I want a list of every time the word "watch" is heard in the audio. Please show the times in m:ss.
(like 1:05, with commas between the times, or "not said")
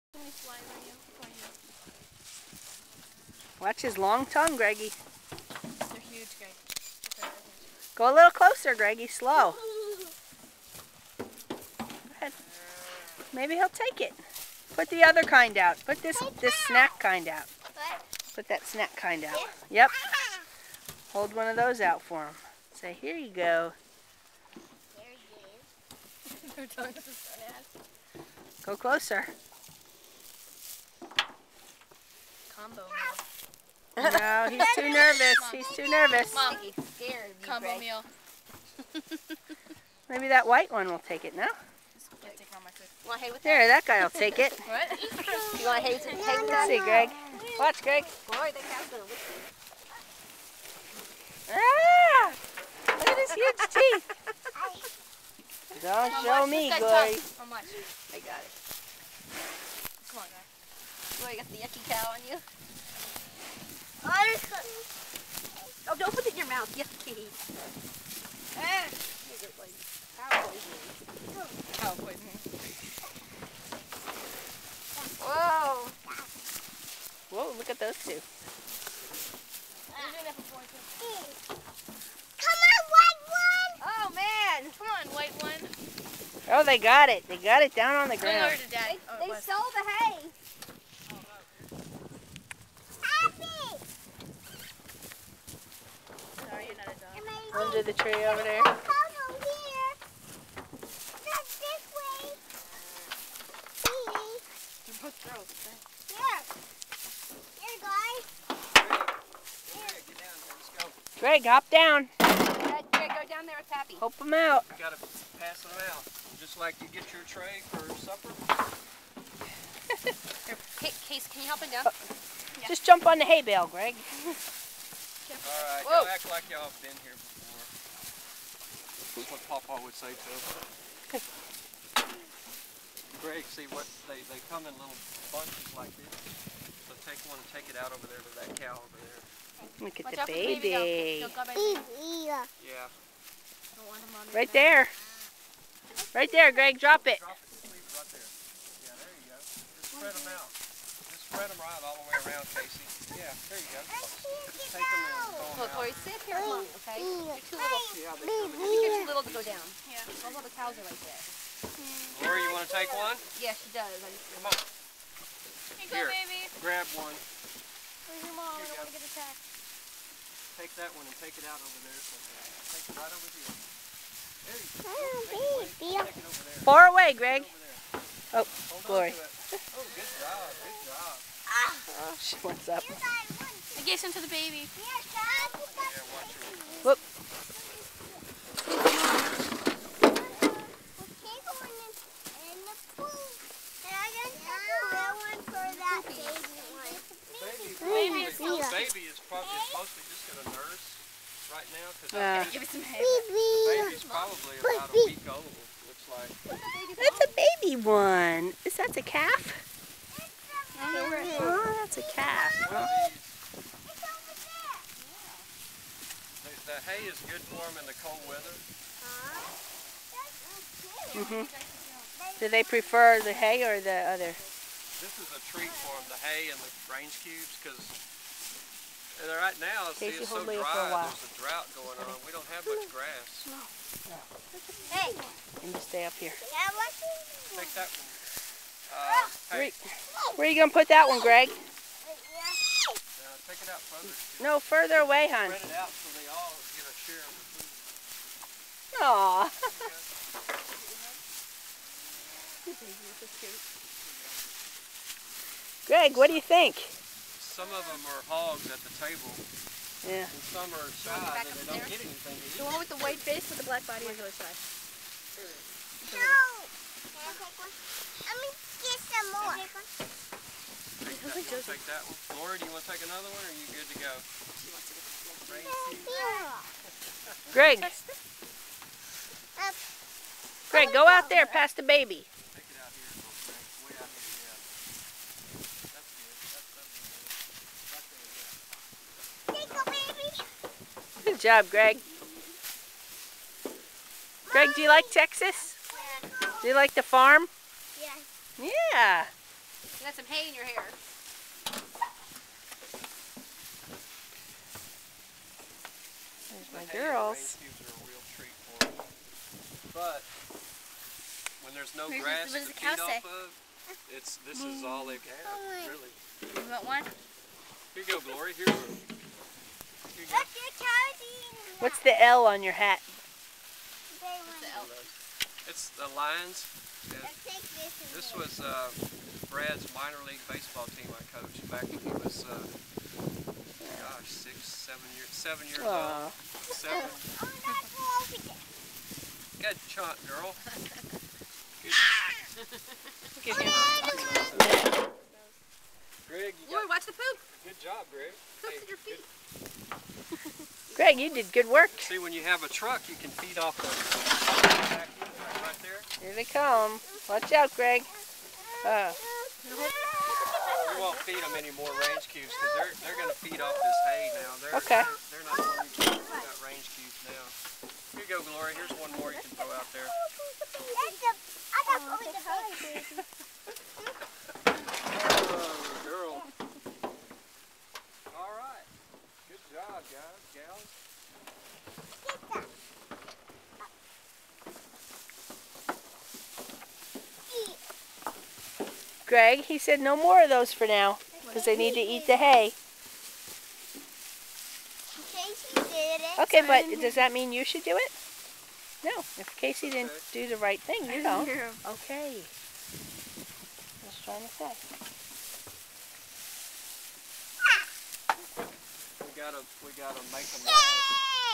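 0:03, 0:47, 2:20, 5:46, 5:57.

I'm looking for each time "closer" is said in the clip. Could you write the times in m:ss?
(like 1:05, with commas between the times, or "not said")
0:08, 0:28.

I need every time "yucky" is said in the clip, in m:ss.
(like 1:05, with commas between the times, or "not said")
1:01, 1:06.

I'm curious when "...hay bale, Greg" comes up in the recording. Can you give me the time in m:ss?
2:03.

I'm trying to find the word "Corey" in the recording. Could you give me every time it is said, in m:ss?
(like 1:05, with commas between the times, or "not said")
2:35, 2:42.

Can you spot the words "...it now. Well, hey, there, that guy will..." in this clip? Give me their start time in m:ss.
0:41.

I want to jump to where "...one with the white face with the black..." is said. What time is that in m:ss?
4:22.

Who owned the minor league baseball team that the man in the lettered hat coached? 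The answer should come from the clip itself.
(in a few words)
Brad's.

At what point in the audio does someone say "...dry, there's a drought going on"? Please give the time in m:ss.
3:50.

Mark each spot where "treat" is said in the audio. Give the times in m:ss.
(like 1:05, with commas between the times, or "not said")
3:45.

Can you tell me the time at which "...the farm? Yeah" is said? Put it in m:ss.
4:56.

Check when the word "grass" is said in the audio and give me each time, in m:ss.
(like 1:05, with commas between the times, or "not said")
3:52, 5:12.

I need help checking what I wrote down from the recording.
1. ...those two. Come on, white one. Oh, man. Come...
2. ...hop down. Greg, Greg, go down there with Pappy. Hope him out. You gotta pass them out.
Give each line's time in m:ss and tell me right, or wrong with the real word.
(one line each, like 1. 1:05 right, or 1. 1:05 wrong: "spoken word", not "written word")
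1. 1:17 right
2. 1:51 right.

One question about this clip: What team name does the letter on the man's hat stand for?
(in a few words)
Lions.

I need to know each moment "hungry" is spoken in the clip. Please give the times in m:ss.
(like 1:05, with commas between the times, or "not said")
6:05.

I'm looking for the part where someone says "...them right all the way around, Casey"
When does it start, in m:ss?
2:31.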